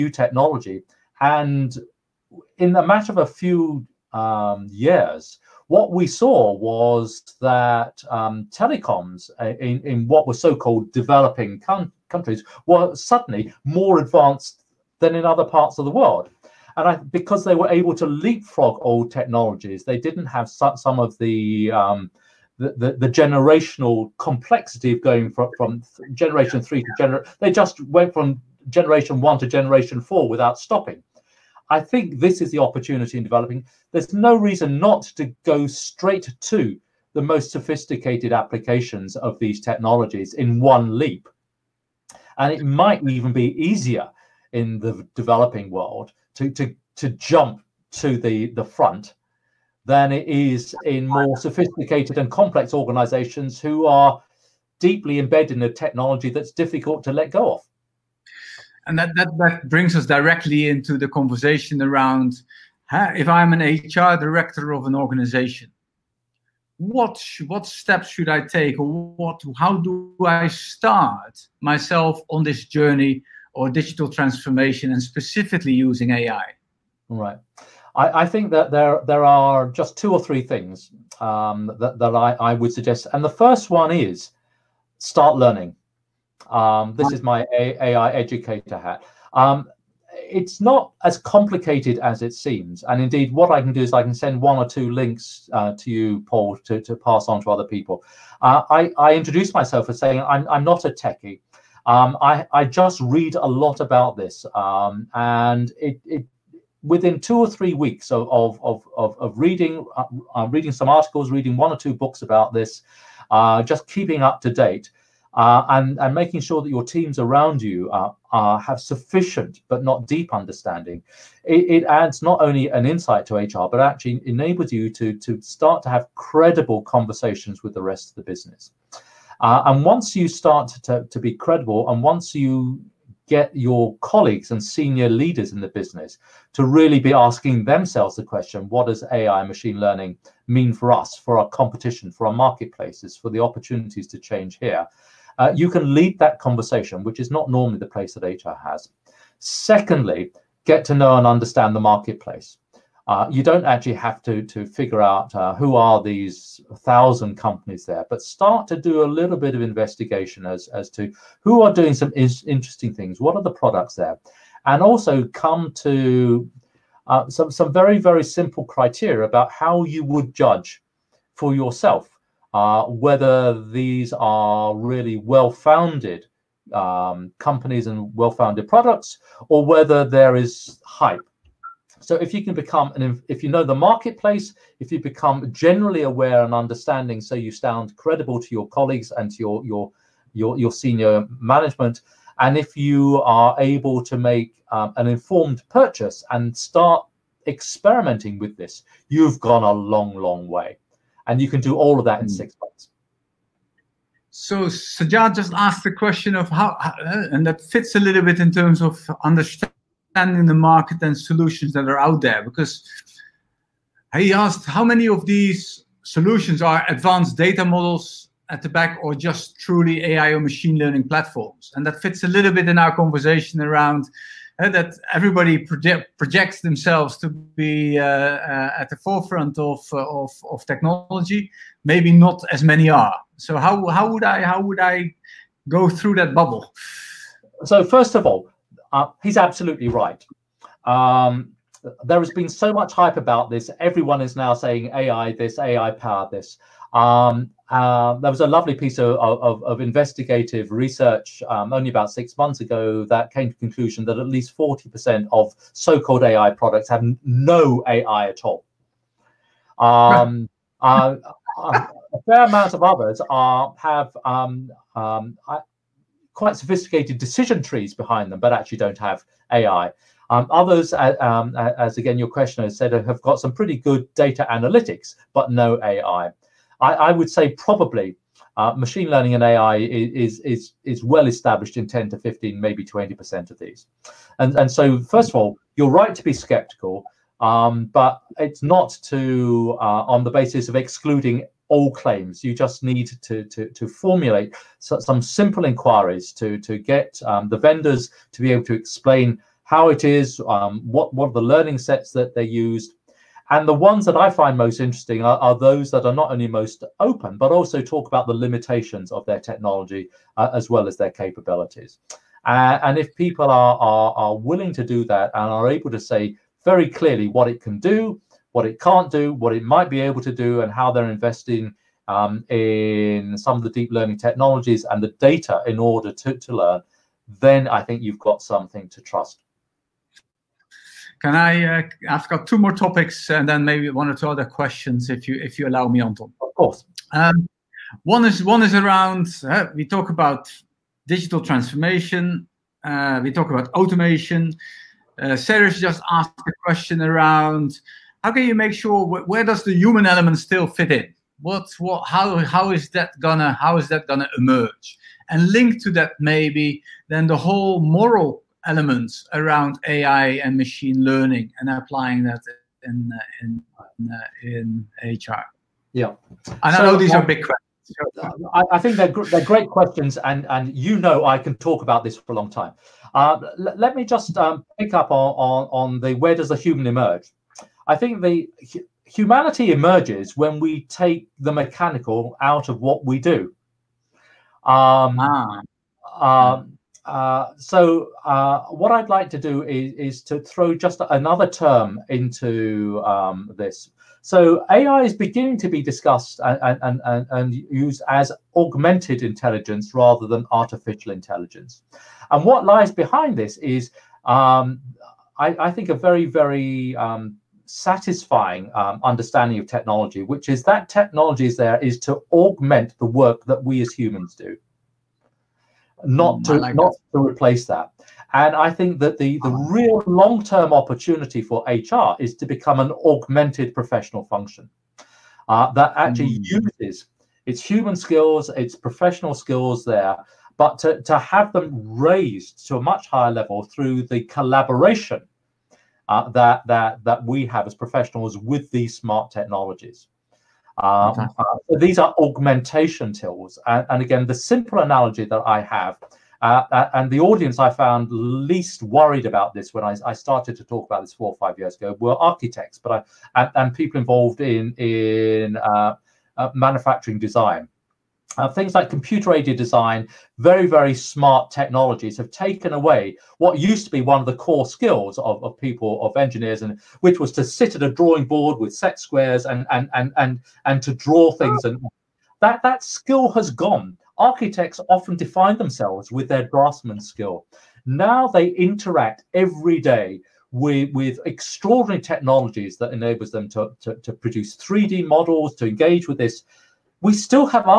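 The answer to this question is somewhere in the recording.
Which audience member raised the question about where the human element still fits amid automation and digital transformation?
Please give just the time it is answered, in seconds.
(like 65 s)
345 s.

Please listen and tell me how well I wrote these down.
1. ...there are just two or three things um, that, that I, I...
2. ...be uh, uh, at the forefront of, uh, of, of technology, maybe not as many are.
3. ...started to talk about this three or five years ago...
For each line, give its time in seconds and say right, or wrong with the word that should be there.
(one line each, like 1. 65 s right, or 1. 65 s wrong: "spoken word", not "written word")
1. 79 s right
2. 227 s right
3. 450 s wrong: "four", not "three".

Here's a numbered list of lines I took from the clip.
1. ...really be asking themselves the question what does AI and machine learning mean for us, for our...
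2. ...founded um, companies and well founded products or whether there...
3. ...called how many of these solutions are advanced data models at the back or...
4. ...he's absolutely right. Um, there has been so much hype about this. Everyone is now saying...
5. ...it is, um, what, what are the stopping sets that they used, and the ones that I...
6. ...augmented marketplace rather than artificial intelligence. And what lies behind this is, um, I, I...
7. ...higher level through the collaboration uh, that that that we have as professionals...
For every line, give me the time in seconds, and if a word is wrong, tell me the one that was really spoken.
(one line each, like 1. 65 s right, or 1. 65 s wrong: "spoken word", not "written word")
1. 136 s right
2. 175 s right
3. 214 s wrong: "asked", not "called"
4. 239 s right
5. 299 s wrong: "learning", not "stopping"
6. 398 s wrong: "intelligence", not "marketplace"
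7. 433 s right.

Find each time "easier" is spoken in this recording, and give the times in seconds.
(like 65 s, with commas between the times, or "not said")
43 s.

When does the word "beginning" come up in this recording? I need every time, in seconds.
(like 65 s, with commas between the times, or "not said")
395 s.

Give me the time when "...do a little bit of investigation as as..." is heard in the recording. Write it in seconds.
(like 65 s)
158 s.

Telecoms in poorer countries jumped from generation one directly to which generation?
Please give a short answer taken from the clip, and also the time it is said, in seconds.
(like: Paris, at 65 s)
generation four, at 29 s.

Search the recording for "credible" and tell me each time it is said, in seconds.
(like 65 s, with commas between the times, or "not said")
126 s, 131 s, 187 s.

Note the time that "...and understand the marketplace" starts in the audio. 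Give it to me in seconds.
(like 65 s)
151 s.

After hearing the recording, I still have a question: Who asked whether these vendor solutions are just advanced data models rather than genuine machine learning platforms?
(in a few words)
Sajad.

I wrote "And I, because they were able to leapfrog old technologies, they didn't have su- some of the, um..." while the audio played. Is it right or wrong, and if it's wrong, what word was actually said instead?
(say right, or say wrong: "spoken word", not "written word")
right.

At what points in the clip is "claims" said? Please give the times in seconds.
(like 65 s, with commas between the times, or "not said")
291 s.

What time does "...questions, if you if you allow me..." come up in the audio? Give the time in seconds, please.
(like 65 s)
334 s.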